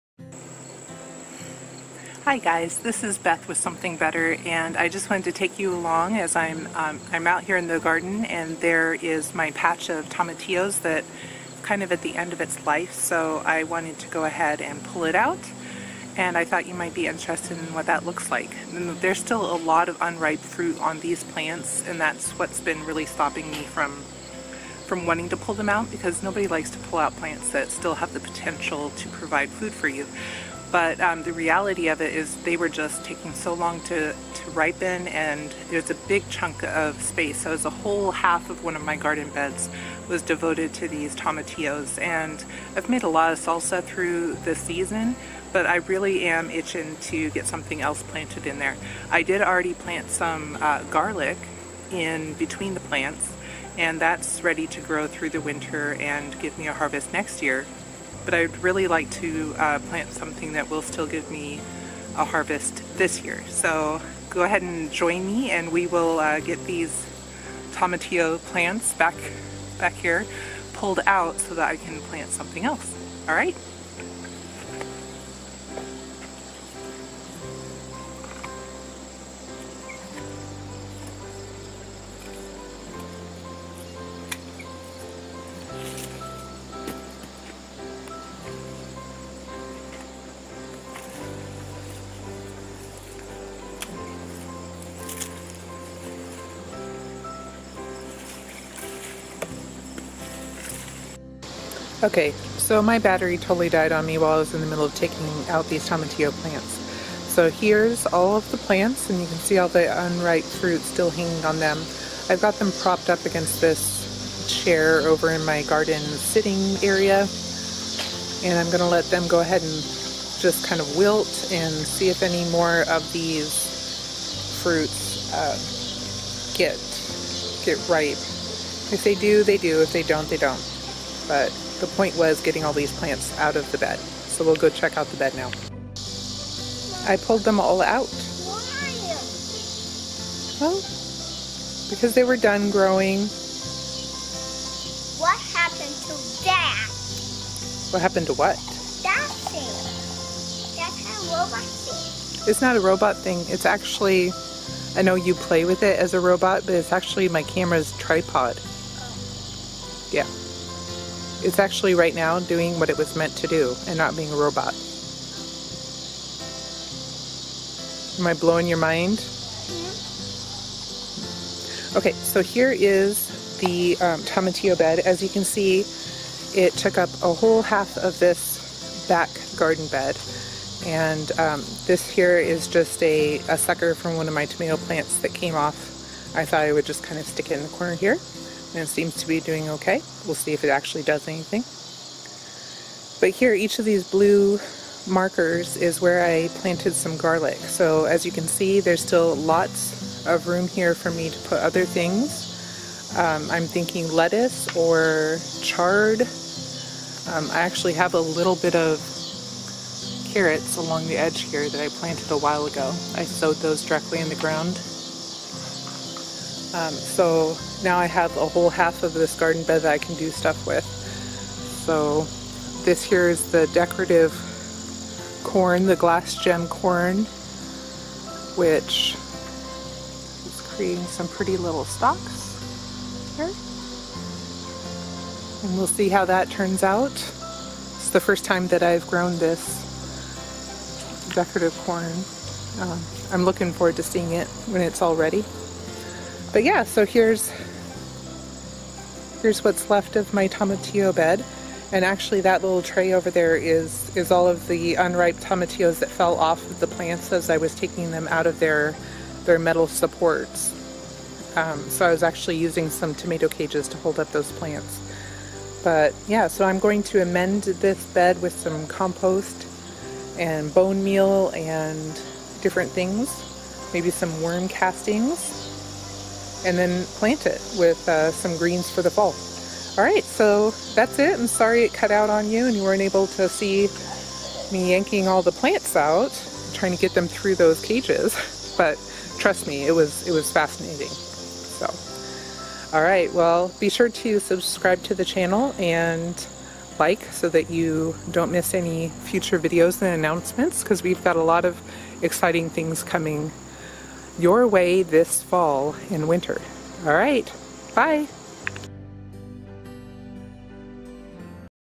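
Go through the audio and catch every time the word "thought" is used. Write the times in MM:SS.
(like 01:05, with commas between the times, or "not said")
00:16, 03:06.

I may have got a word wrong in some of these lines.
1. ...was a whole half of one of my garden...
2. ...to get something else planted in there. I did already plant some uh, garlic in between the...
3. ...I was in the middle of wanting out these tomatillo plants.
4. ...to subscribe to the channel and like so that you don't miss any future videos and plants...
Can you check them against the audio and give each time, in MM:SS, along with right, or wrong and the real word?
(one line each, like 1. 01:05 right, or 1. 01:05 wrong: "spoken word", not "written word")
1. 00:37 right
2. 00:47 right
3. 01:44 wrong: "taking", not "wanting"
4. 04:54 wrong: "announcements", not "plants".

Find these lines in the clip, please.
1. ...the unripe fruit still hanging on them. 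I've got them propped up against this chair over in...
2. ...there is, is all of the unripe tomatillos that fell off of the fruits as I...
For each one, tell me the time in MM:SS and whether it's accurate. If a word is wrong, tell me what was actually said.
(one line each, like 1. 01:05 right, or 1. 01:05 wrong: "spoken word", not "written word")
1. 01:49 right
2. 04:13 wrong: "plants", not "fruits".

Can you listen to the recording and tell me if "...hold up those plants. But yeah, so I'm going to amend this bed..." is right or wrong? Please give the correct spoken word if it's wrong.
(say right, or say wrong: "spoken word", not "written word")
right.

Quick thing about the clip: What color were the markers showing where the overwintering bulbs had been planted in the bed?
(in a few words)
Blue.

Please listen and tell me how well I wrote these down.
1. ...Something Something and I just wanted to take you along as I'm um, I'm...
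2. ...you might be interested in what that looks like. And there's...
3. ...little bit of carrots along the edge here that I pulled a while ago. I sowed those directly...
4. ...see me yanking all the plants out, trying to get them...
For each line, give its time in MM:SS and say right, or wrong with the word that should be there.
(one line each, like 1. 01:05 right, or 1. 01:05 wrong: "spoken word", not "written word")
1. 00:03 wrong: "Better", not "Something"
2. 00:16 right
3. 03:28 wrong: "planted", not "pulled"
4. 04:43 right.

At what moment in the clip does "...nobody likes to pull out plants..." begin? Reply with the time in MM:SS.
00:26.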